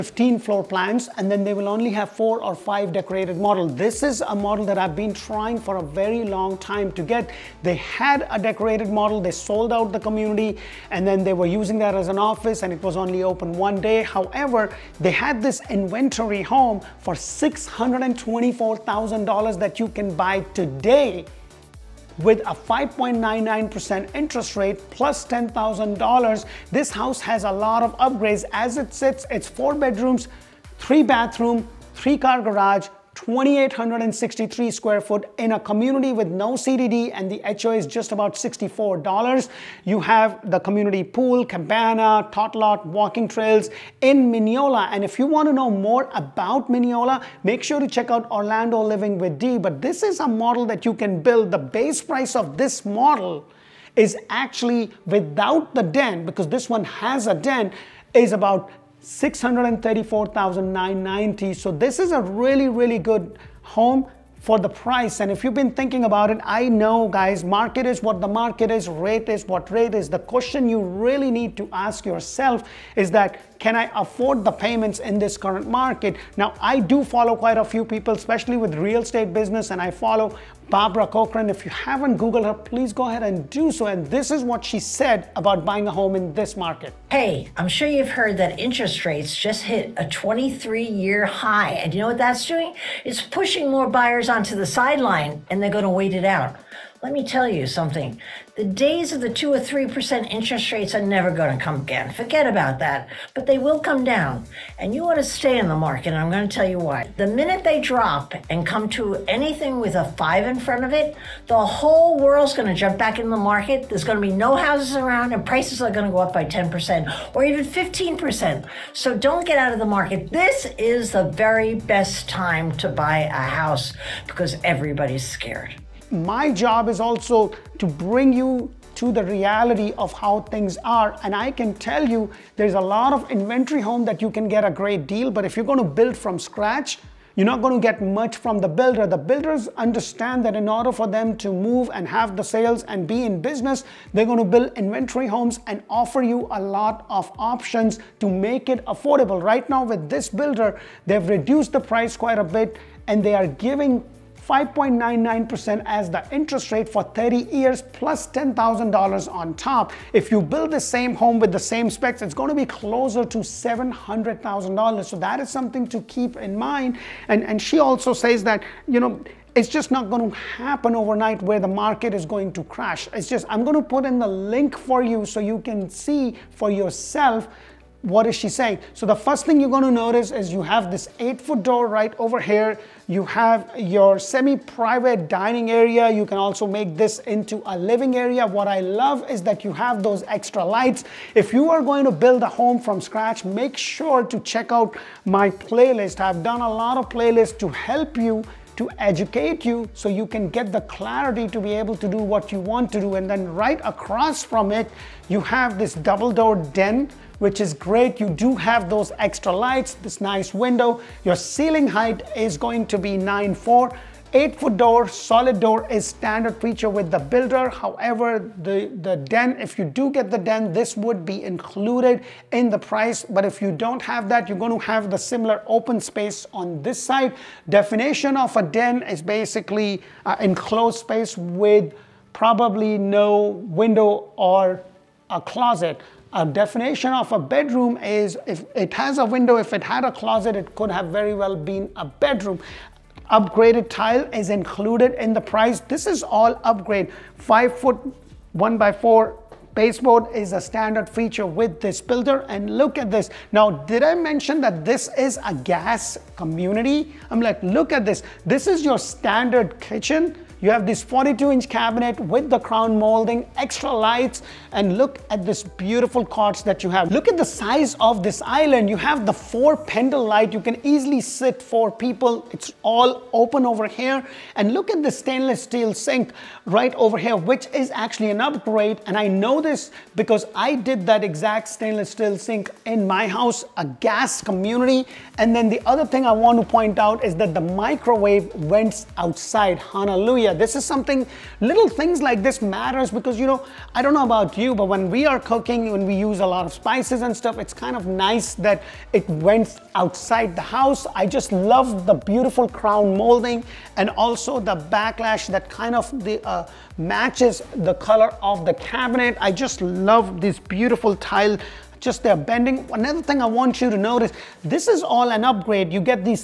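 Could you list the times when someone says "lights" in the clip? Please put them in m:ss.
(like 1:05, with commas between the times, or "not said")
3:10, 3:29, 4:23, 4:30.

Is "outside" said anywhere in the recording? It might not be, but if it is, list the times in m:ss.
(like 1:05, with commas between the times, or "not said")
4:49, 4:59.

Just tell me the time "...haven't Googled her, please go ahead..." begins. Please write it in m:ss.
1:21.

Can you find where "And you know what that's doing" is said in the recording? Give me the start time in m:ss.
1:31.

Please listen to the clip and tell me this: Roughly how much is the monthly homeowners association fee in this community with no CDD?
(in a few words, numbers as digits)
$64.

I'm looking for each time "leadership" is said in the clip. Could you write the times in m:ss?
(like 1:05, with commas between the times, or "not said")
not said.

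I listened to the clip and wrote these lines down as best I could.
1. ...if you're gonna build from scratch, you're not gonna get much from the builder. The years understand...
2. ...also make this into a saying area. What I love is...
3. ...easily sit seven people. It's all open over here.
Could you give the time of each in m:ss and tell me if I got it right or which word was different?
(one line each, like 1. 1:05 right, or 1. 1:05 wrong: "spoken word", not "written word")
1. 2:15 wrong: "builders", not "years"
2. 3:06 wrong: "living", not "saying"
3. 4:30 wrong: "four", not "seven".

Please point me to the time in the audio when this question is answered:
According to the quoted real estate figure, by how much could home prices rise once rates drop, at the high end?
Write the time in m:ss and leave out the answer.
1:57.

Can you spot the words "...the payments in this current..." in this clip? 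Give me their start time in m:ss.
1:14.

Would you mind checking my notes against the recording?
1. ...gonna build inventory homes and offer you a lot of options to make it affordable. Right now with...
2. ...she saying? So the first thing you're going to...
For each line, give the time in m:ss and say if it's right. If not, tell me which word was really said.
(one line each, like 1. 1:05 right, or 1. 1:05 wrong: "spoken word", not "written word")
1. 2:24 right
2. 2:58 right.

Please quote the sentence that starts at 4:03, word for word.
Upgraded tile is included in the price.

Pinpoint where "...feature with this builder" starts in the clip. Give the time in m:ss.
4:11.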